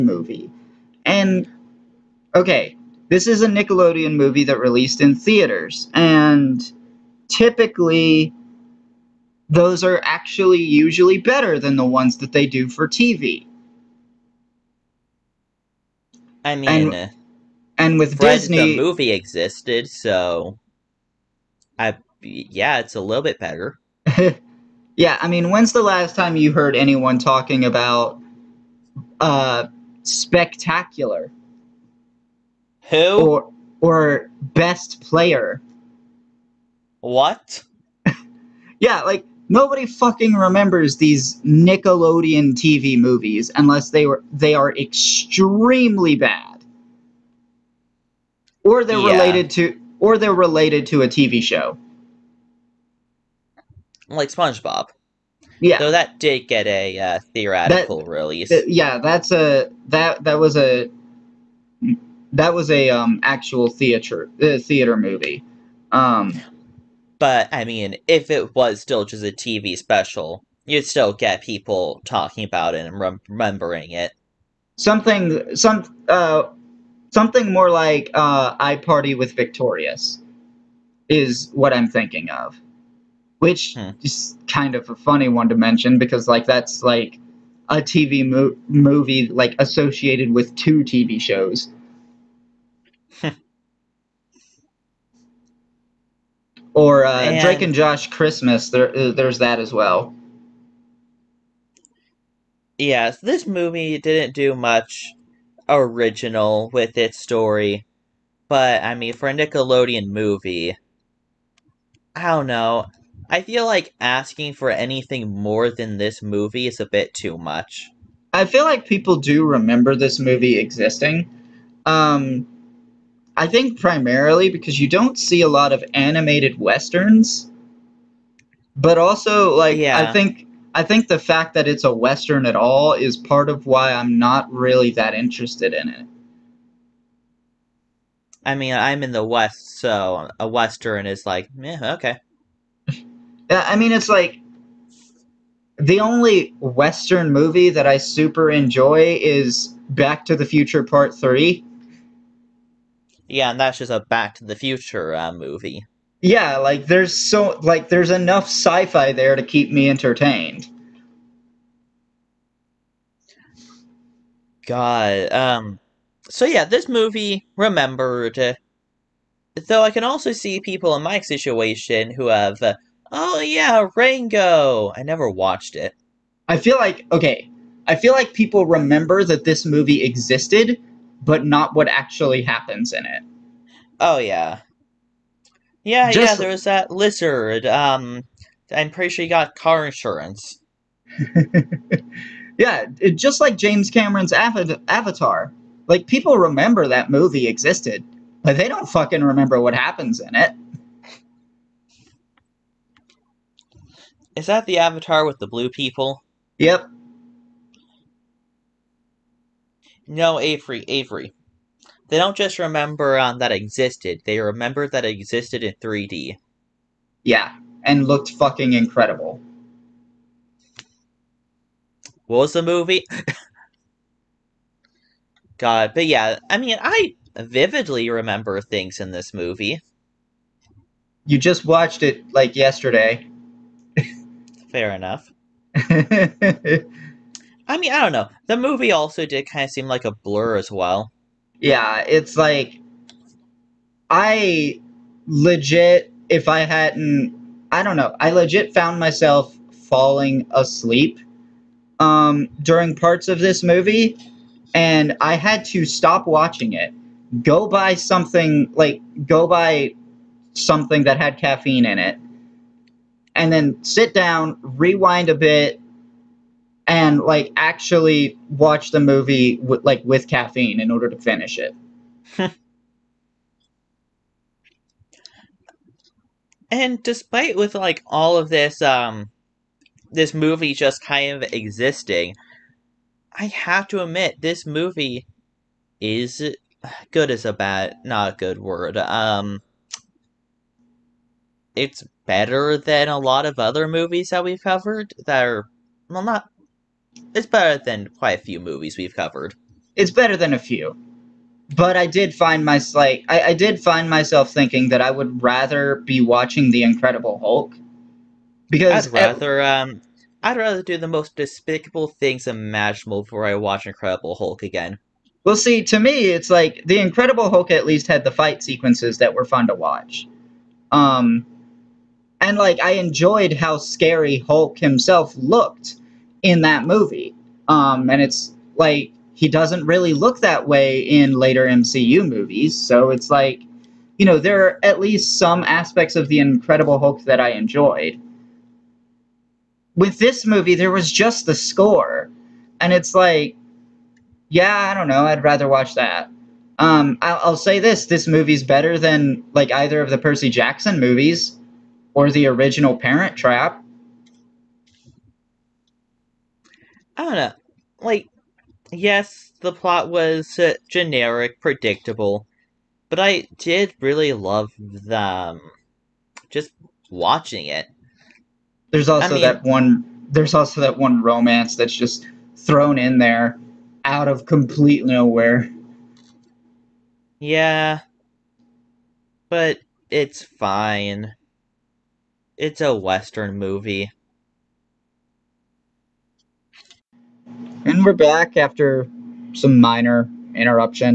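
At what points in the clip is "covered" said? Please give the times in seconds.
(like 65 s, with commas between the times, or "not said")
294 s, 299 s.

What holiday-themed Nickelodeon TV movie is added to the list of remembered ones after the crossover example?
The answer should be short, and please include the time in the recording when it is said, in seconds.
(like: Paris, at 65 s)
Drake and Josh Christmas, at 97 s.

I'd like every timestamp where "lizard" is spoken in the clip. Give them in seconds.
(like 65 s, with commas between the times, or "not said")
186 s.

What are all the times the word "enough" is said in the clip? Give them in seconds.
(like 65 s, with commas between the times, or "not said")
158 s, 234 s.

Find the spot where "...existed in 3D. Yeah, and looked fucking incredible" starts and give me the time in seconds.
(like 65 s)
215 s.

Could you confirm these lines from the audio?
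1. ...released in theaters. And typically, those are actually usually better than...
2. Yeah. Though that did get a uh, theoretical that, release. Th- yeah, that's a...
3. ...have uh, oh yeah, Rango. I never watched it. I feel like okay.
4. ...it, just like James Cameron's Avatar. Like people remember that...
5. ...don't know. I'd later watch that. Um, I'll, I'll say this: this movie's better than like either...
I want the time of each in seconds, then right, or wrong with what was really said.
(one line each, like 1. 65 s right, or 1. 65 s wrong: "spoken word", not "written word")
1. 4 s right
2. 55 s right
3. 172 s right
4. 192 s right
5. 344 s wrong: "rather", not "later".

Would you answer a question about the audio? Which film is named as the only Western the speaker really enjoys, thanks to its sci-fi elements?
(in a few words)
Back to the Future Part 3.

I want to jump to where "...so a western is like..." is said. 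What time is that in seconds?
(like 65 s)
139 s.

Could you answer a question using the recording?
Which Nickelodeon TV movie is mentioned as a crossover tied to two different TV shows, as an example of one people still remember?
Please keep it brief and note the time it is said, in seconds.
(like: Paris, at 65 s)
iParty with Victorious, at 78 s.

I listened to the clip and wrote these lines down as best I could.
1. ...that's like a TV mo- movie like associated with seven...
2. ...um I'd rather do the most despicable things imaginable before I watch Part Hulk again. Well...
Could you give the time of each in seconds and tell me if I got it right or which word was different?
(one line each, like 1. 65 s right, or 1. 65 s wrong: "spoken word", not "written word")
1. 86 s wrong: "two", not "seven"
2. 309 s wrong: "Incredible", not "Part".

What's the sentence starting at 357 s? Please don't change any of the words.
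Like, yes, the plot was uh, generic, predictable, but I did really love them.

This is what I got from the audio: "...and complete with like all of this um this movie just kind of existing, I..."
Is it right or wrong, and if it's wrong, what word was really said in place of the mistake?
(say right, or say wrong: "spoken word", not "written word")
wrong: "despite", not "complete".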